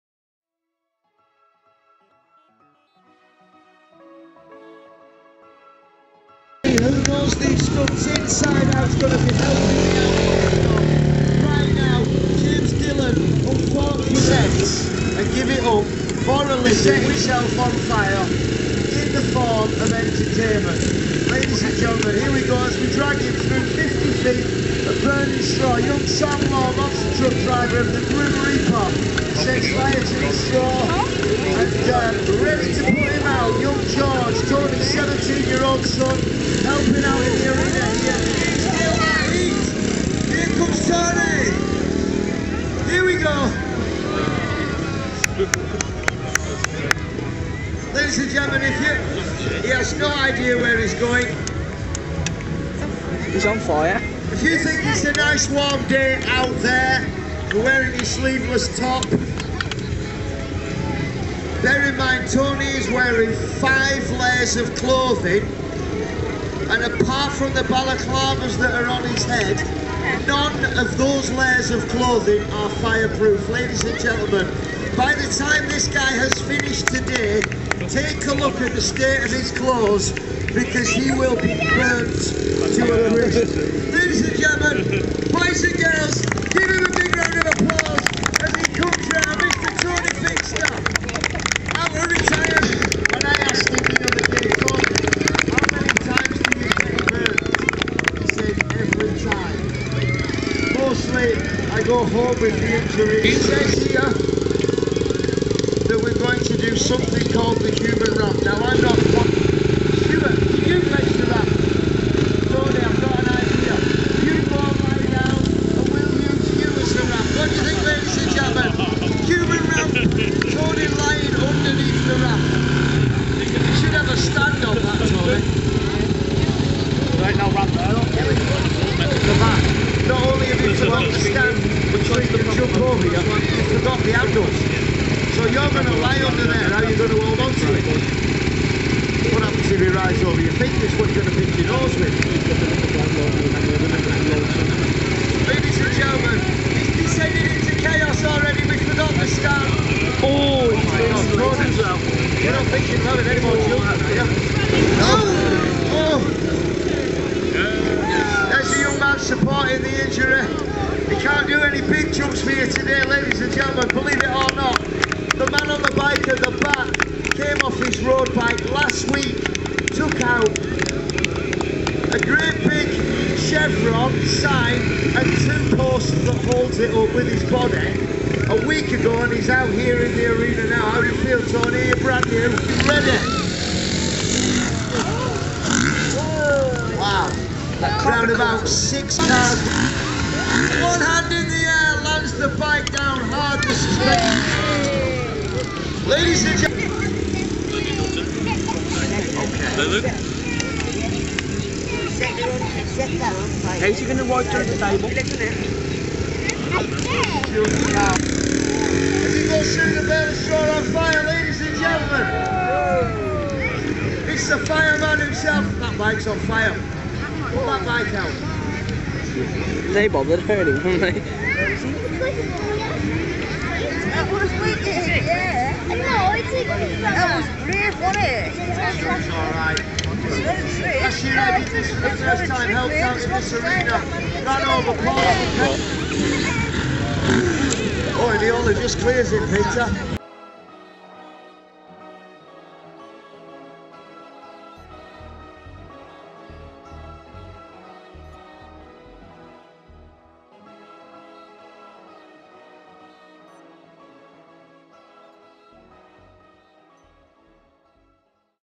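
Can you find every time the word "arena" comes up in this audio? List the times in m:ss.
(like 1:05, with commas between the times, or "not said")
0:37, 3:00.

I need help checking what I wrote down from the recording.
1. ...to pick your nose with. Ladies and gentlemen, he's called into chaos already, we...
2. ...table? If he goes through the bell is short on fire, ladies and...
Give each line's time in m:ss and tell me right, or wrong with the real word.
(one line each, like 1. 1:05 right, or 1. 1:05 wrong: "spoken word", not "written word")
1. 2:21 wrong: "descended", not "called"
2. 3:24 right.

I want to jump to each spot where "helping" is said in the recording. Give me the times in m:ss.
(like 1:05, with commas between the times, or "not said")
0:09, 0:36.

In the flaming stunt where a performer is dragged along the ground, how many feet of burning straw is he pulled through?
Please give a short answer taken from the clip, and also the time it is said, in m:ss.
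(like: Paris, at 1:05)
50, at 0:23.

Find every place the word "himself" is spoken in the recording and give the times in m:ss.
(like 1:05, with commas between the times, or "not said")
0:17, 3:35.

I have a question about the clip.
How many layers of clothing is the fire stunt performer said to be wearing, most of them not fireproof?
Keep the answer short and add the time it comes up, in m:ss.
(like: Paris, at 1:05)
5, at 1:03.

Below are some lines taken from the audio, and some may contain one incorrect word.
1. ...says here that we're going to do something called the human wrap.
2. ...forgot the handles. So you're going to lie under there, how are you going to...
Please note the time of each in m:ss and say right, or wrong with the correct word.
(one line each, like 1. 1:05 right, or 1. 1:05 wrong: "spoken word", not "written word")
1. 1:43 right
2. 2:13 right.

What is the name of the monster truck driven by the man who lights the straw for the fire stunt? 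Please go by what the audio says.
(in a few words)
Grim Reaper.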